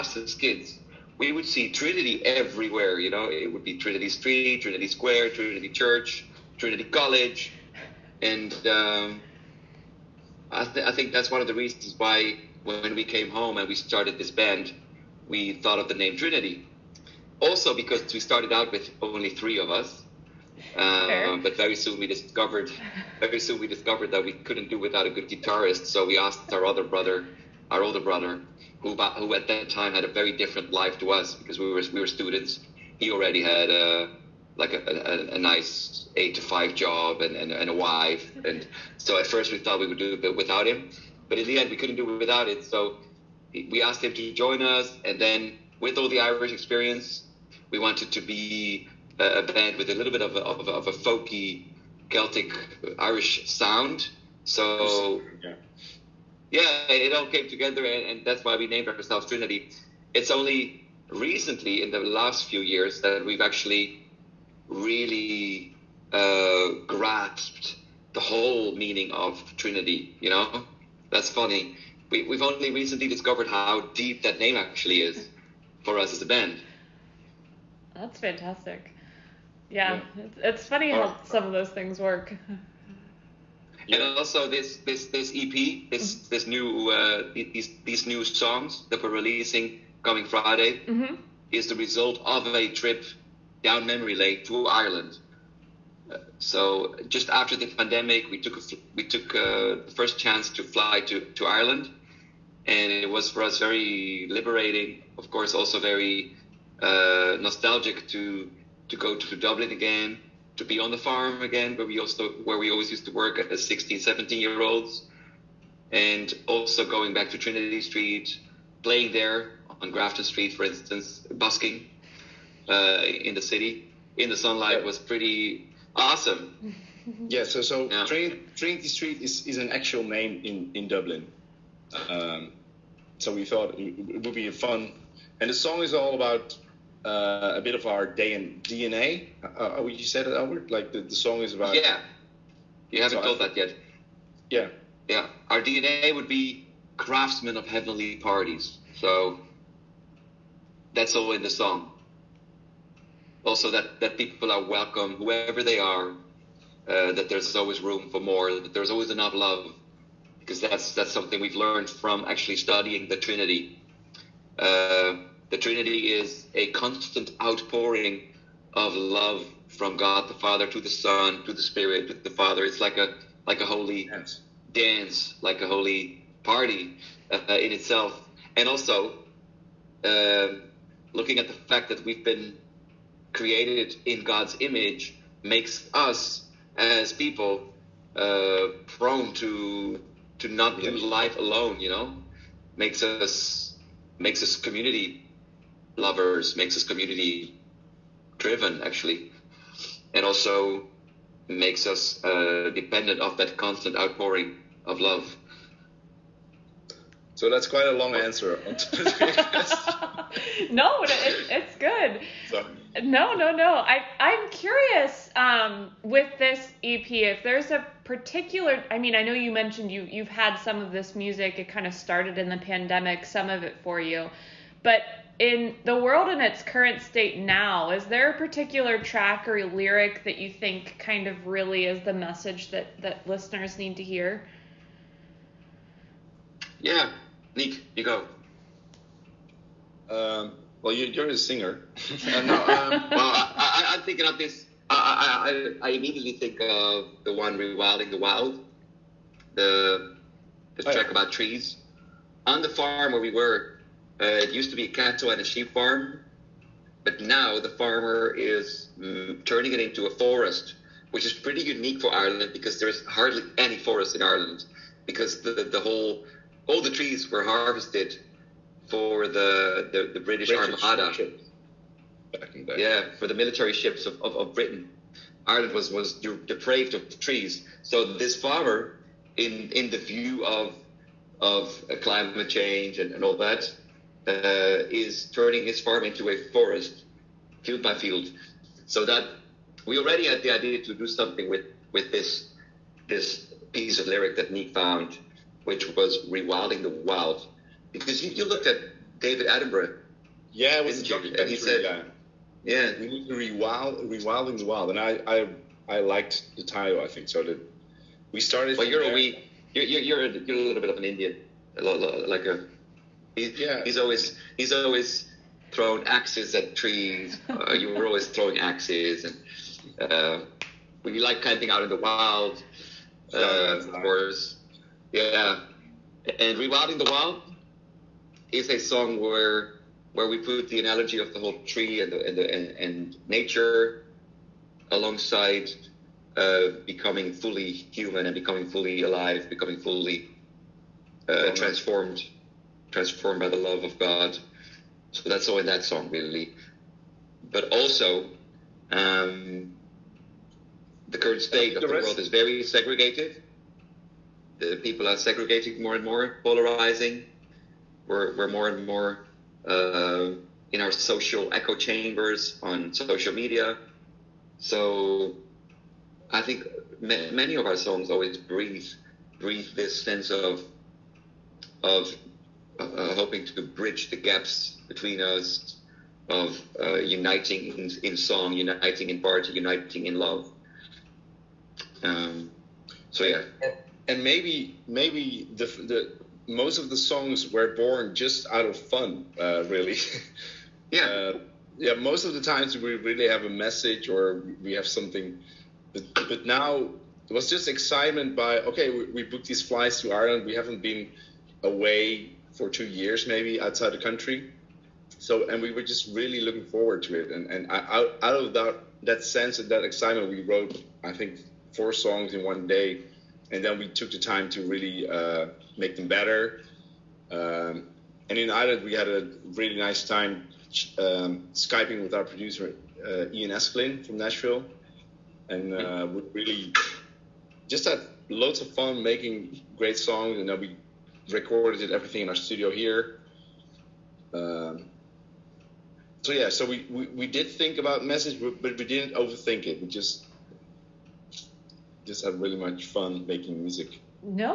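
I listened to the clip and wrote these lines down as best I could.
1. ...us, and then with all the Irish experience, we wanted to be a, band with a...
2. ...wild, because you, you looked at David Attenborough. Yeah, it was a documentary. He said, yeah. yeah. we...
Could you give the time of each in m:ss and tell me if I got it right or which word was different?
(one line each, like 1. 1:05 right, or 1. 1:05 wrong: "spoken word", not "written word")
1. 0:44 right
2. 4:56 right.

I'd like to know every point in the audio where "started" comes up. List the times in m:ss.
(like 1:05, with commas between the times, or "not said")
0:13, 0:18, 3:41, 5:08.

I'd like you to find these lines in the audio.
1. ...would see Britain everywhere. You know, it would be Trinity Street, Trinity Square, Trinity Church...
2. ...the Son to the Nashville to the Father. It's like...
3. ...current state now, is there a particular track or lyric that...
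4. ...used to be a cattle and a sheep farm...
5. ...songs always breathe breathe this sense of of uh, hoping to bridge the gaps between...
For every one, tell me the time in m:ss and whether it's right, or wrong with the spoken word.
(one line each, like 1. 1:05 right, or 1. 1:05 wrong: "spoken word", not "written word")
1. 0:01 wrong: "Trinity", not "Britain"
2. 2:50 wrong: "Spirit", not "Nashville"
3. 3:46 right
4. 4:14 right
5. 6:07 right.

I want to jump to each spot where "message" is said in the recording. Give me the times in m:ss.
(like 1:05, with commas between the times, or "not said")
3:52, 6:33, 7:18.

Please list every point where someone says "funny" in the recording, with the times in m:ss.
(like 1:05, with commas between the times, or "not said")
1:11, 1:20.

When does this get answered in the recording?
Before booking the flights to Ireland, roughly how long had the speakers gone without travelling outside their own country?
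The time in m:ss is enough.
6:42.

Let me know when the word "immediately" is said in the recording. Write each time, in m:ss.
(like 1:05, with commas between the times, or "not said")
4:05.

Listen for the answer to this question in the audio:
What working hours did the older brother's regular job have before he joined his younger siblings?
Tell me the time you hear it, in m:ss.
0:36.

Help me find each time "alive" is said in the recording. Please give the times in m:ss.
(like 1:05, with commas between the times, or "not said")
5:39.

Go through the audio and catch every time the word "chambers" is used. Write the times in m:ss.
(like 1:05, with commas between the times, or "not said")
6:01.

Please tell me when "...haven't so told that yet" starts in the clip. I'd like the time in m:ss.
2:23.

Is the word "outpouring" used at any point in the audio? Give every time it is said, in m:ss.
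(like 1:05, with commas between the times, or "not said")
2:47, 3:23.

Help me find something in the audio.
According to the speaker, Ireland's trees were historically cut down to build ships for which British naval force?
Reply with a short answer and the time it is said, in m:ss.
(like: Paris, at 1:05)
Armada, at 4:30.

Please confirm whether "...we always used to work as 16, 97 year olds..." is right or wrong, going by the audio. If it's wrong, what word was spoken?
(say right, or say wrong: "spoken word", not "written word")
wrong: "17", not "97".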